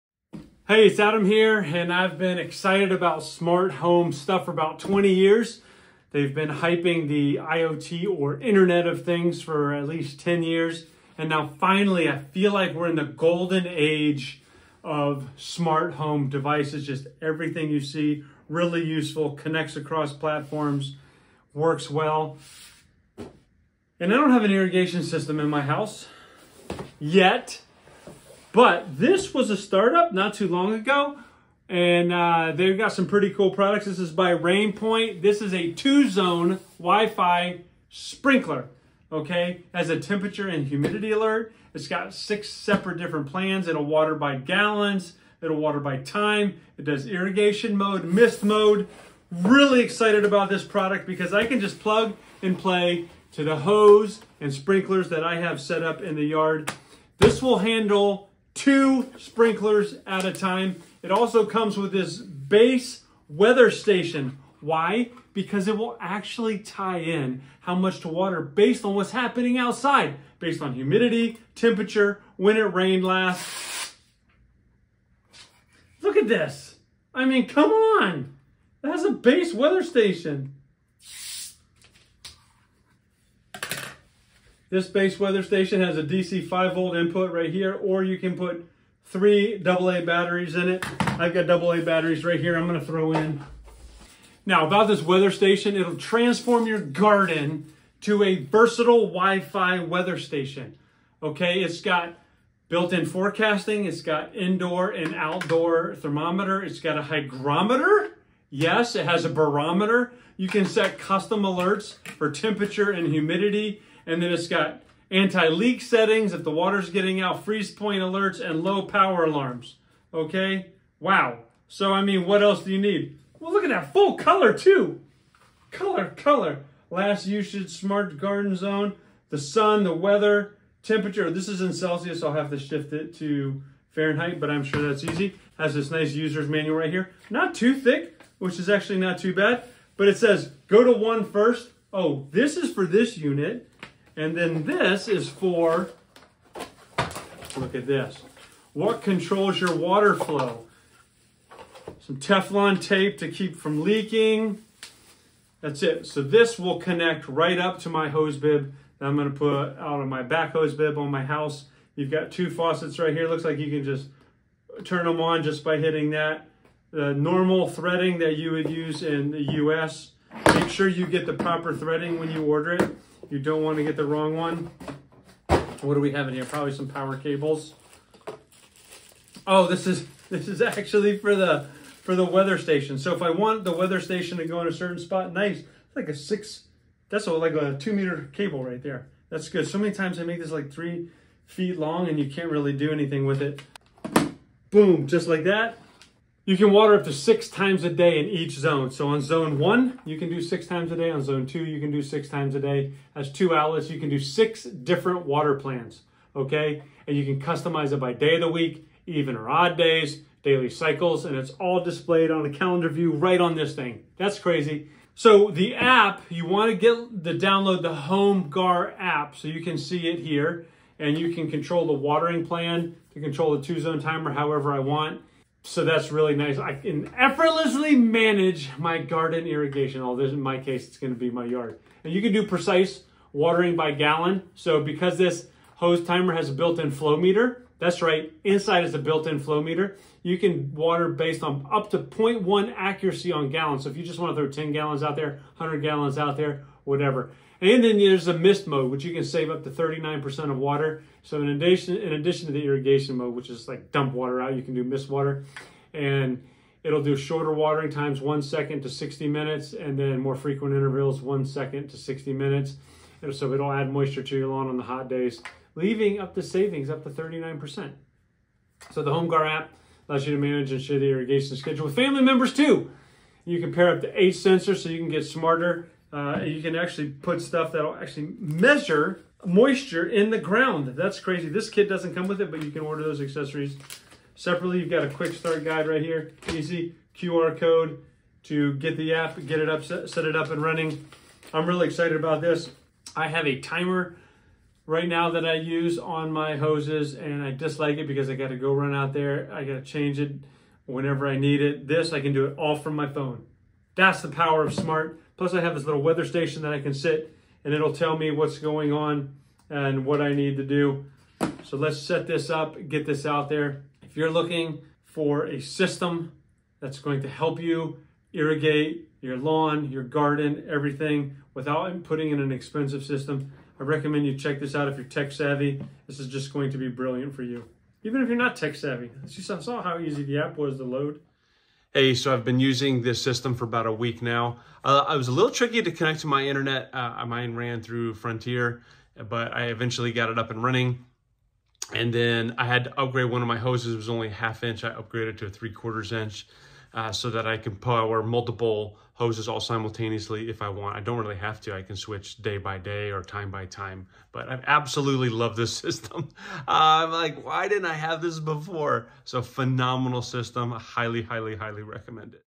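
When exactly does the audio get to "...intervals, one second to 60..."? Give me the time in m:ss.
4:20.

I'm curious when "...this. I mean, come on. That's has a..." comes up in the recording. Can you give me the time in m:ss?
1:16.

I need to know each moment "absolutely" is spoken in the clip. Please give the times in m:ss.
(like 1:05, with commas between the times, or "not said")
5:54.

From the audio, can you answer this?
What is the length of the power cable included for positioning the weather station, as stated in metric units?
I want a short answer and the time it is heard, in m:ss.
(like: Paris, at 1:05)
2 meters, at 3:07.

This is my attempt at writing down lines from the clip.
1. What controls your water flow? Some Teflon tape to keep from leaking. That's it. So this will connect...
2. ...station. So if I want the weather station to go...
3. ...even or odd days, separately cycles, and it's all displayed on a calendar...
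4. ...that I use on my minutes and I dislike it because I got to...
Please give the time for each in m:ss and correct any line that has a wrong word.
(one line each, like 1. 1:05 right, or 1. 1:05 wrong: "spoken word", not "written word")
1. 2:28 right
2. 3:02 right
3. 3:29 wrong: "daily", not "separately"
4. 4:55 wrong: "hoses", not "minutes".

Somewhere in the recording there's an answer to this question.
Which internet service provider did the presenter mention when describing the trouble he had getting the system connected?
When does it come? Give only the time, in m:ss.
5:38.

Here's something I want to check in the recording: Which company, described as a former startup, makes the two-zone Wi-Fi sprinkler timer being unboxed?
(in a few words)
Rainpoint.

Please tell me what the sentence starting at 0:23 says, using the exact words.
And I don't have an irrigation system in my house yet.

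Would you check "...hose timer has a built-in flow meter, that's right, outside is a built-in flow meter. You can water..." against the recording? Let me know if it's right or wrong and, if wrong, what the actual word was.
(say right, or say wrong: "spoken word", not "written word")
wrong: "inside", not "outside".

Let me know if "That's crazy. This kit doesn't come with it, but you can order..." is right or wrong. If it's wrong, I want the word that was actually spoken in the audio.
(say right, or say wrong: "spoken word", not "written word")
right.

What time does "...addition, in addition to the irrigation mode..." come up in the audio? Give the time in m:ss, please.
4:11.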